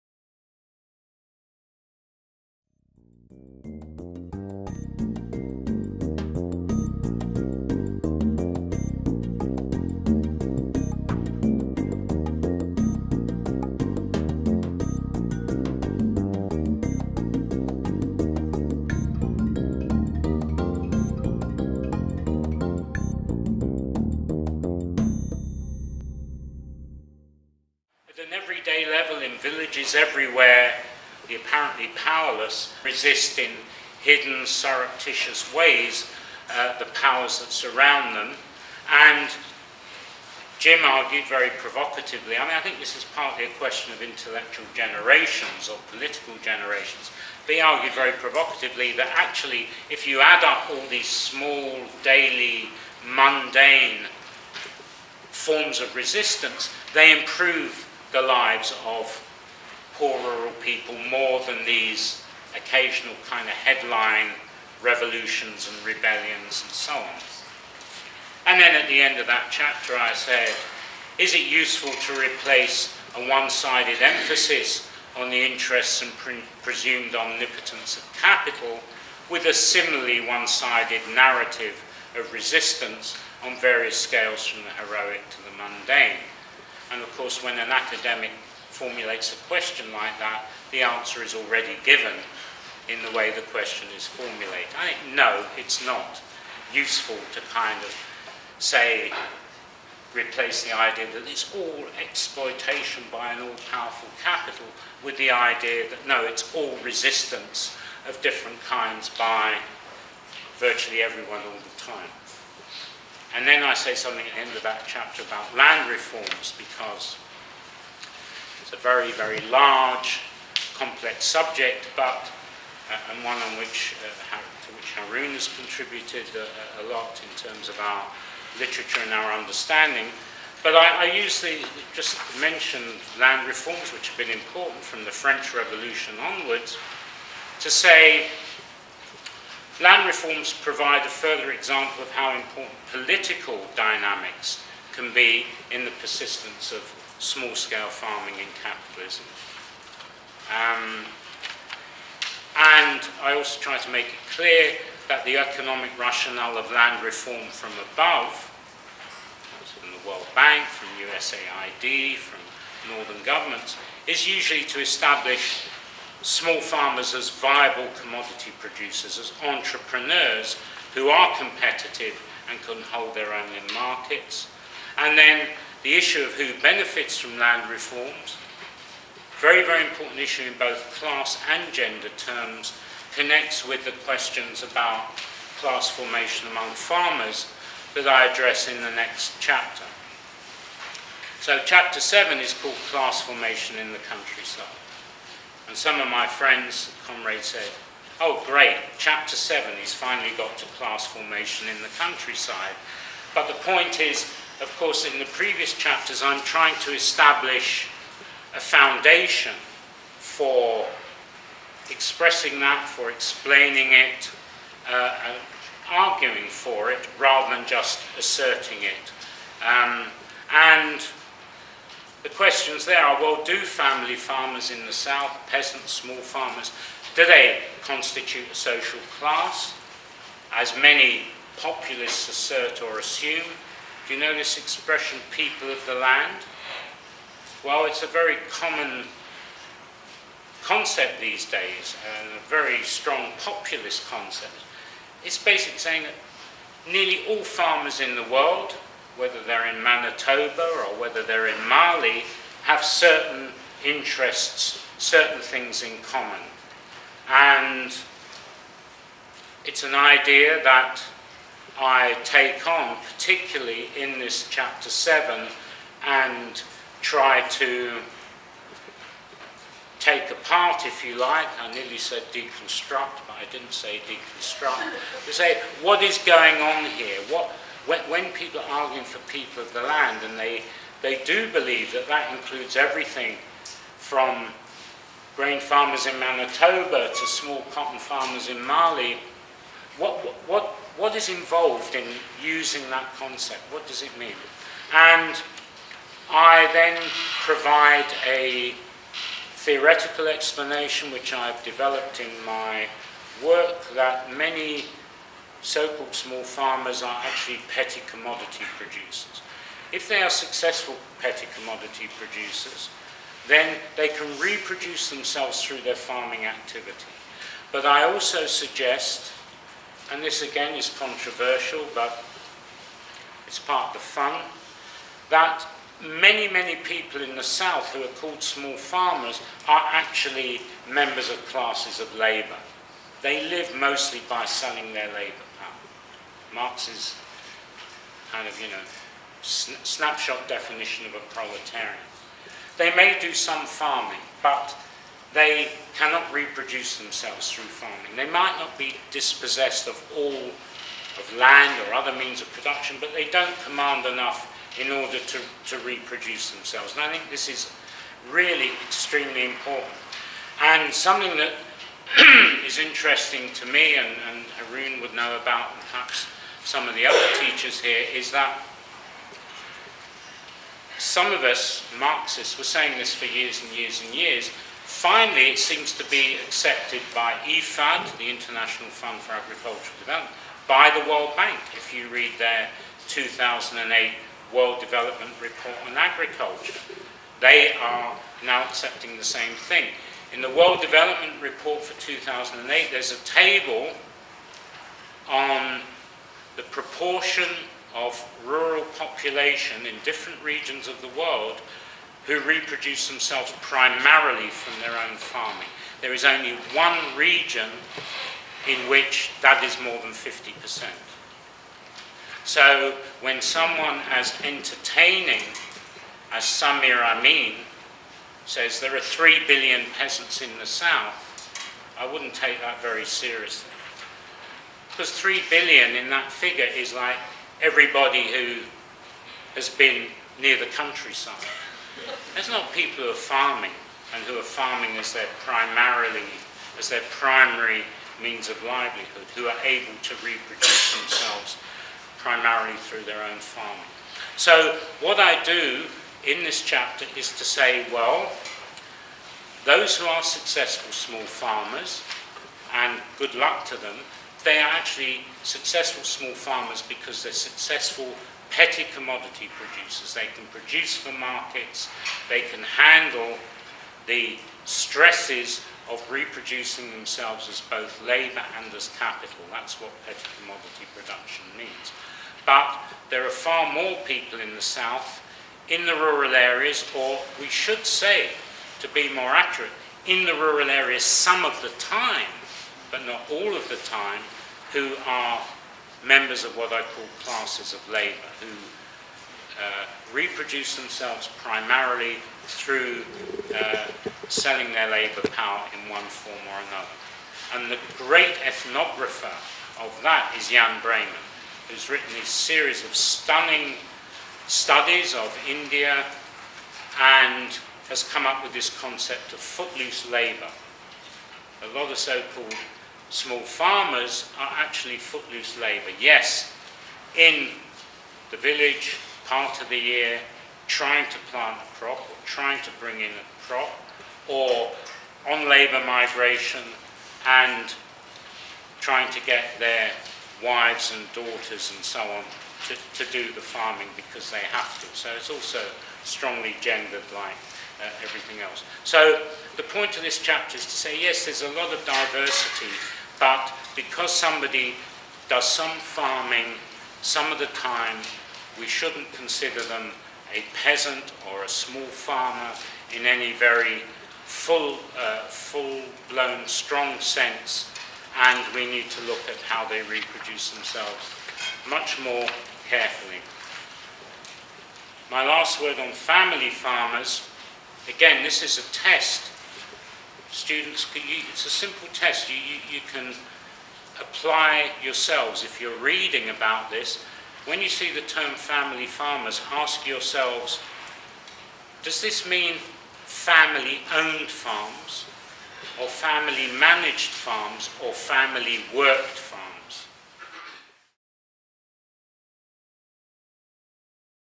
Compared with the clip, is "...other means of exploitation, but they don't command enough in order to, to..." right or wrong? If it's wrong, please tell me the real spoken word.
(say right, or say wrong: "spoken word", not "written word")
wrong: "production", not "exploitation".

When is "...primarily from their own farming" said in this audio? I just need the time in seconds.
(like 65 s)
403 s.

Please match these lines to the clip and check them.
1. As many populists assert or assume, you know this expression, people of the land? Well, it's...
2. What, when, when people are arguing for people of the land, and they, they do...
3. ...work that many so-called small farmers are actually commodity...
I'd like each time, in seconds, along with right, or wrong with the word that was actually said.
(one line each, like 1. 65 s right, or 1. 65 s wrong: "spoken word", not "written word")
1. 230 s right
2. 277 s right
3. 303 s wrong: "petty", not "commodity".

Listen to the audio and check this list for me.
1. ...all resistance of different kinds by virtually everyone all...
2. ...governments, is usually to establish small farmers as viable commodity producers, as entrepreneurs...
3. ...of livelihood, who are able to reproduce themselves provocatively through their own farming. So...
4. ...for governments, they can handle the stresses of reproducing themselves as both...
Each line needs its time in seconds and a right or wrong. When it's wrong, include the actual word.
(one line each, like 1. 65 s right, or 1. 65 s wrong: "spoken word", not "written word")
1. 106 s right
2. 163 s right
3. 438 s wrong: "primarily", not "provocatively"
4. 460 s wrong: "markets", not "governments".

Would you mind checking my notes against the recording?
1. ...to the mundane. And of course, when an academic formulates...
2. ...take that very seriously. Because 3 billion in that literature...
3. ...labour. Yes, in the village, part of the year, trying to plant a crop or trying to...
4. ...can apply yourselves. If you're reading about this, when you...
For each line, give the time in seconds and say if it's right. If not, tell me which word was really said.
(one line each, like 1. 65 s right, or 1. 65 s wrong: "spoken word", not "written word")
1. 85 s right
2. 422 s wrong: "figure", not "literature"
3. 515 s right
4. 572 s right.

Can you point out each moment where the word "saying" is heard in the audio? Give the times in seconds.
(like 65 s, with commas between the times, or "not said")
245 s, 372 s.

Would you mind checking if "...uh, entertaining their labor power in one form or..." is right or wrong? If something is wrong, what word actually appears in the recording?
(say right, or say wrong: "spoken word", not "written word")
wrong: "selling", not "entertaining".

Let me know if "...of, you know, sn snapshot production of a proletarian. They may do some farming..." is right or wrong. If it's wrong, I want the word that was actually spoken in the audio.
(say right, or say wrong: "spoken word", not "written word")
wrong: "definition", not "production".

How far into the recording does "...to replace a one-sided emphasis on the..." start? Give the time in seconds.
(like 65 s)
71 s.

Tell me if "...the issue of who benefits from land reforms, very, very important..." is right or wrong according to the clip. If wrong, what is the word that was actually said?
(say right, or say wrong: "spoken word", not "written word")
right.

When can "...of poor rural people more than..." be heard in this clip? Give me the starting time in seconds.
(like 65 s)
58 s.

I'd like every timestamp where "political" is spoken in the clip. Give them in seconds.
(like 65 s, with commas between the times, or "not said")
45 s, 142 s.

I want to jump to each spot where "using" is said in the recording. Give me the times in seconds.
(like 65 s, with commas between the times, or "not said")
292 s.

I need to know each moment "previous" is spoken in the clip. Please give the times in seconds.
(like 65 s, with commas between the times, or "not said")
205 s.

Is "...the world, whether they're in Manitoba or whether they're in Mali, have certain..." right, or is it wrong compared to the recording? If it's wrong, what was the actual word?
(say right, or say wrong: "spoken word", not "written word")
right.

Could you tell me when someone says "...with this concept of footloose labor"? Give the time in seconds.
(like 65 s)
508 s.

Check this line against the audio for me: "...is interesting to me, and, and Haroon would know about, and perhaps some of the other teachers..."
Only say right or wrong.
right.